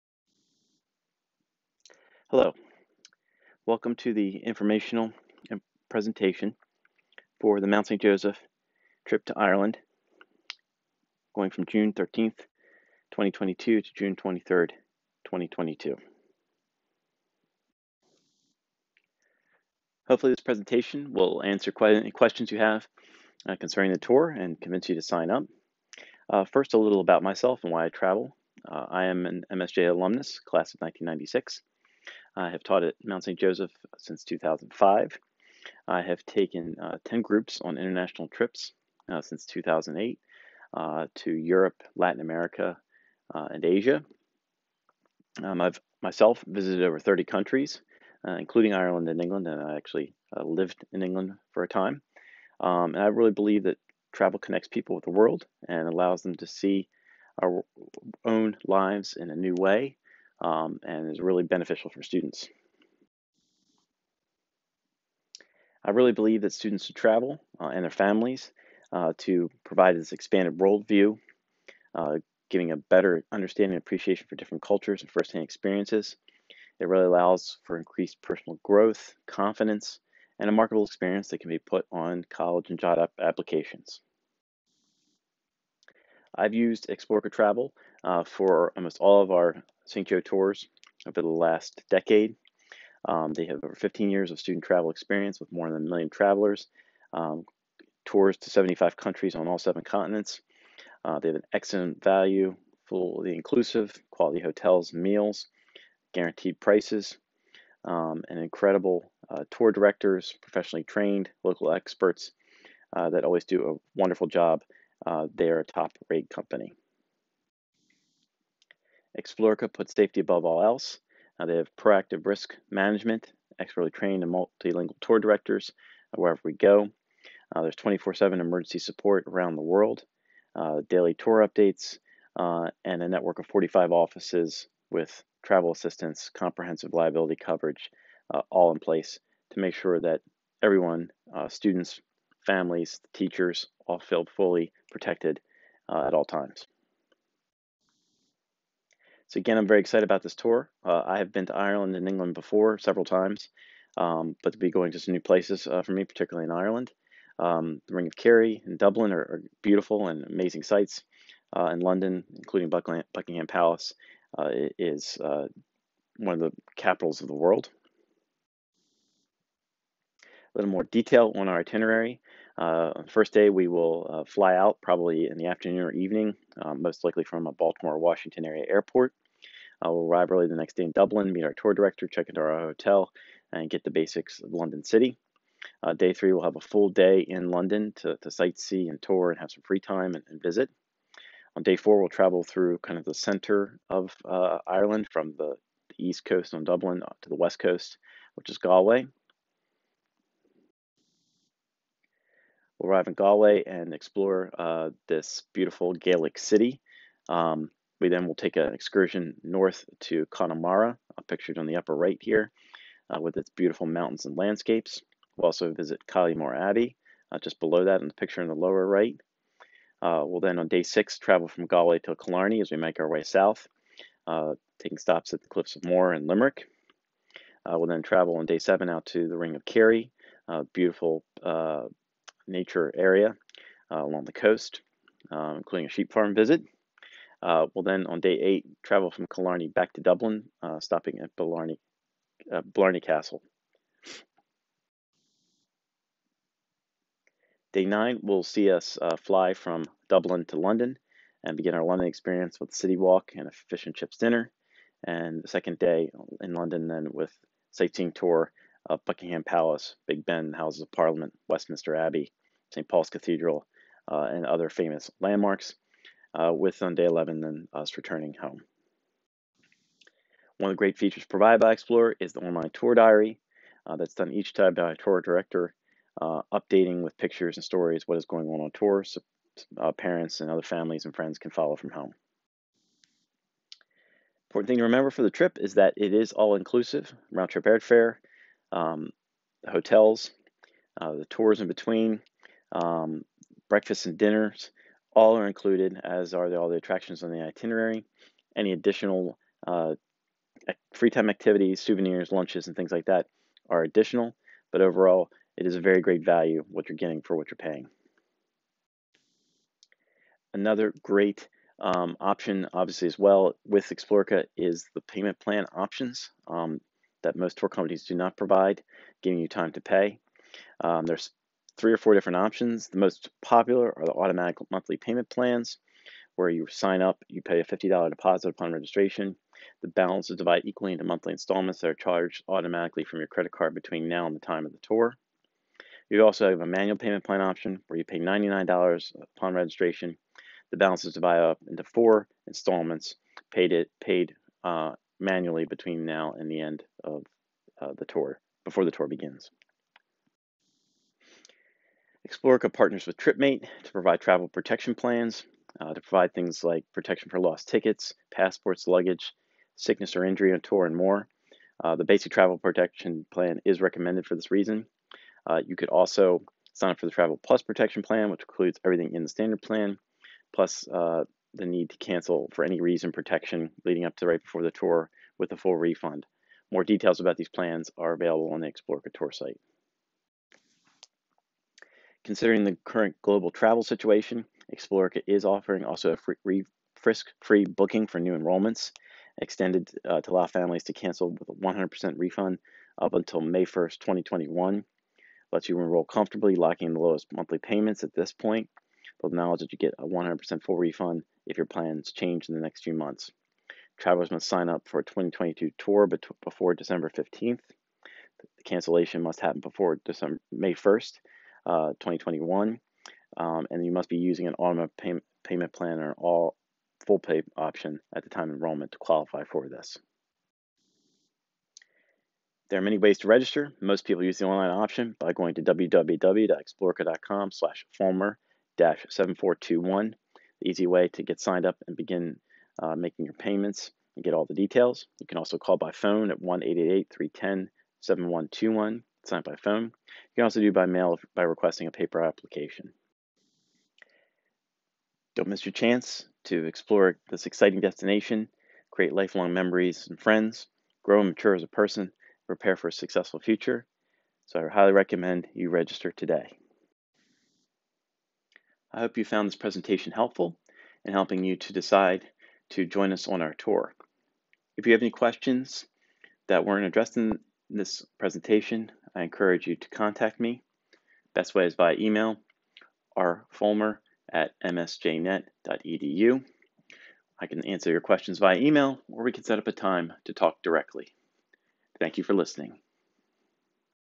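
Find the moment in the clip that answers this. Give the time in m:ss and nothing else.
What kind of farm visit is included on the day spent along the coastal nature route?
3:55.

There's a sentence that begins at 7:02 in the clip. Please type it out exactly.
There are many ways to register.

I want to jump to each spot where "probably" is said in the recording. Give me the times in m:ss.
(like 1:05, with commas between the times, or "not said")
2:54.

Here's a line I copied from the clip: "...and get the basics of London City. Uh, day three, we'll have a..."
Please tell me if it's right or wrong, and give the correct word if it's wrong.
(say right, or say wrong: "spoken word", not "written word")
right.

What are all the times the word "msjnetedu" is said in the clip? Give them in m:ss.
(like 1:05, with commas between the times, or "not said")
7:54.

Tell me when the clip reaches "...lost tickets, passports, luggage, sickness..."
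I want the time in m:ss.
5:57.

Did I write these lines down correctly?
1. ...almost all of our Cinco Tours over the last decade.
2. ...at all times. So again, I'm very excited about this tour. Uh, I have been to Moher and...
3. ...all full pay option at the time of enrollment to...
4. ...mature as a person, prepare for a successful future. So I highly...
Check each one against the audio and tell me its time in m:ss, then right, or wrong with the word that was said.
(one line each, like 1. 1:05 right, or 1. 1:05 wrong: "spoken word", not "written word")
1. 1:28 right
2. 2:26 wrong: "Ireland", not "Moher"
3. 6:56 right
4. 7:31 right.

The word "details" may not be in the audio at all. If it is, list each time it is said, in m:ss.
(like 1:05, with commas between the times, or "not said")
2:50, 6:16, 7:14.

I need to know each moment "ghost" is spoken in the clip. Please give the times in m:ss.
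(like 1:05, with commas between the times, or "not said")
not said.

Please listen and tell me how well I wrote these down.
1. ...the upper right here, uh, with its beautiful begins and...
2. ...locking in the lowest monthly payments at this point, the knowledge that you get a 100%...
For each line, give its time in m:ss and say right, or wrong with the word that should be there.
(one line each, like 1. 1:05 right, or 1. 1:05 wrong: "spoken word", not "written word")
1. 3:31 wrong: "mountains", not "begins"
2. 6:36 right.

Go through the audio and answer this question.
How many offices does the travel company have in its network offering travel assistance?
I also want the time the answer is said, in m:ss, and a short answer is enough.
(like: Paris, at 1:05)
45, at 2:13.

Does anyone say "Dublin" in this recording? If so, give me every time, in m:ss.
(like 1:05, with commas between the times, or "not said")
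2:38, 3:00, 3:16, 4:00, 4:10.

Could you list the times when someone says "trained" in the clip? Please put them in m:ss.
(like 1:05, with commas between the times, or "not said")
1:50, 2:03.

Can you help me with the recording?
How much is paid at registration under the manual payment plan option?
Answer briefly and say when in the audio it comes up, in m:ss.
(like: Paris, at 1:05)
$99, at 5:38.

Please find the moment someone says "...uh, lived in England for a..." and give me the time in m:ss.
0:50.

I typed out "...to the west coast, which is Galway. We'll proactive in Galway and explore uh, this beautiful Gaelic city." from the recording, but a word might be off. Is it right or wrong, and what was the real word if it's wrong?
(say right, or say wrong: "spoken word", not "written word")
wrong: "arrive", not "proactive".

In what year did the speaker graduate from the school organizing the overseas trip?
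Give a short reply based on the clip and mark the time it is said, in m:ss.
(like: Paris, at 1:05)
1996, at 0:30.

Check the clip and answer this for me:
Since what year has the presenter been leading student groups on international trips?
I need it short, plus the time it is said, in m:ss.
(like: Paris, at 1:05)
2008, at 0:39.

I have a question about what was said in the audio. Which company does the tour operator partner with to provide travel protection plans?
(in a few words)
TripMate.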